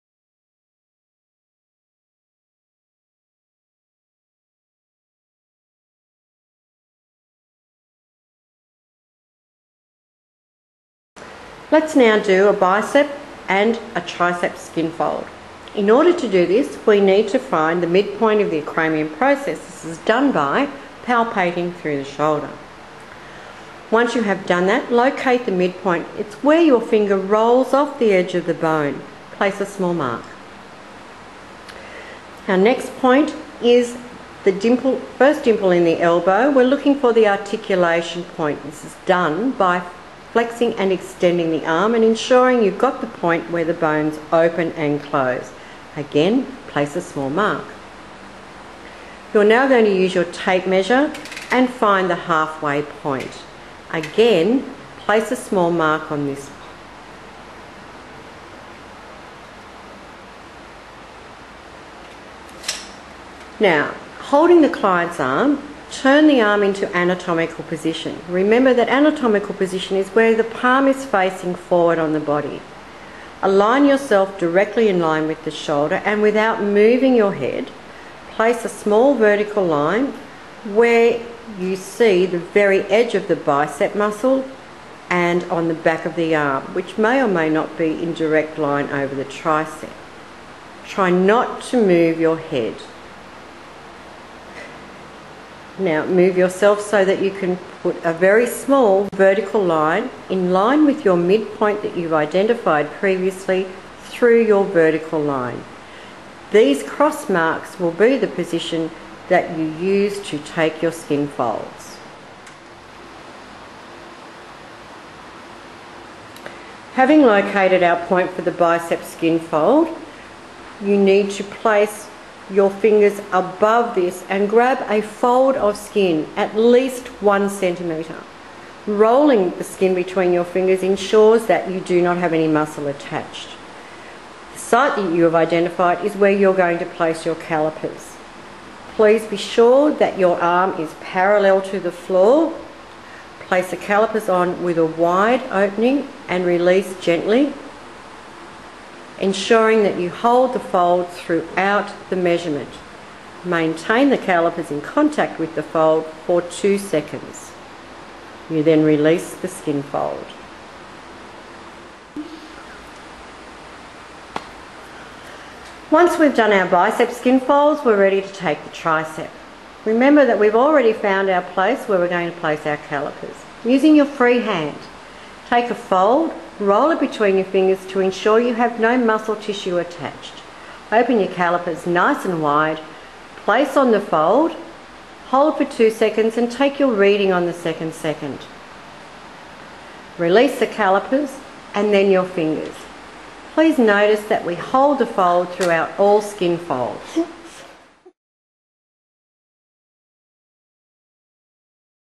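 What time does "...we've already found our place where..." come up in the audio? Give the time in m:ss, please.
2:50.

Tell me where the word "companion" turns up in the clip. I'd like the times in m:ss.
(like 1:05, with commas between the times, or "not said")
not said.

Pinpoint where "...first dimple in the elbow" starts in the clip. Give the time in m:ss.
0:35.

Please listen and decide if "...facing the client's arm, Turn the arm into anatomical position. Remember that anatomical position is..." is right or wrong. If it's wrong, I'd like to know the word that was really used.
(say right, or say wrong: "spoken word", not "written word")
wrong: "holding", not "facing".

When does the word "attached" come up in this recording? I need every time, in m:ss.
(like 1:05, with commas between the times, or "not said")
2:12, 2:59.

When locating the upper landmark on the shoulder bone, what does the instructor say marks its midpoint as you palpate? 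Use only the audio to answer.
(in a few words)
where your finger rolls off the edge.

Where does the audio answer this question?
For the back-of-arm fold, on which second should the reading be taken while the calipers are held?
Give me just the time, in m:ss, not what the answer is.
3:07.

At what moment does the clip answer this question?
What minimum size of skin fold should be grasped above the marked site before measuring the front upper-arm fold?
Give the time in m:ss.
2:07.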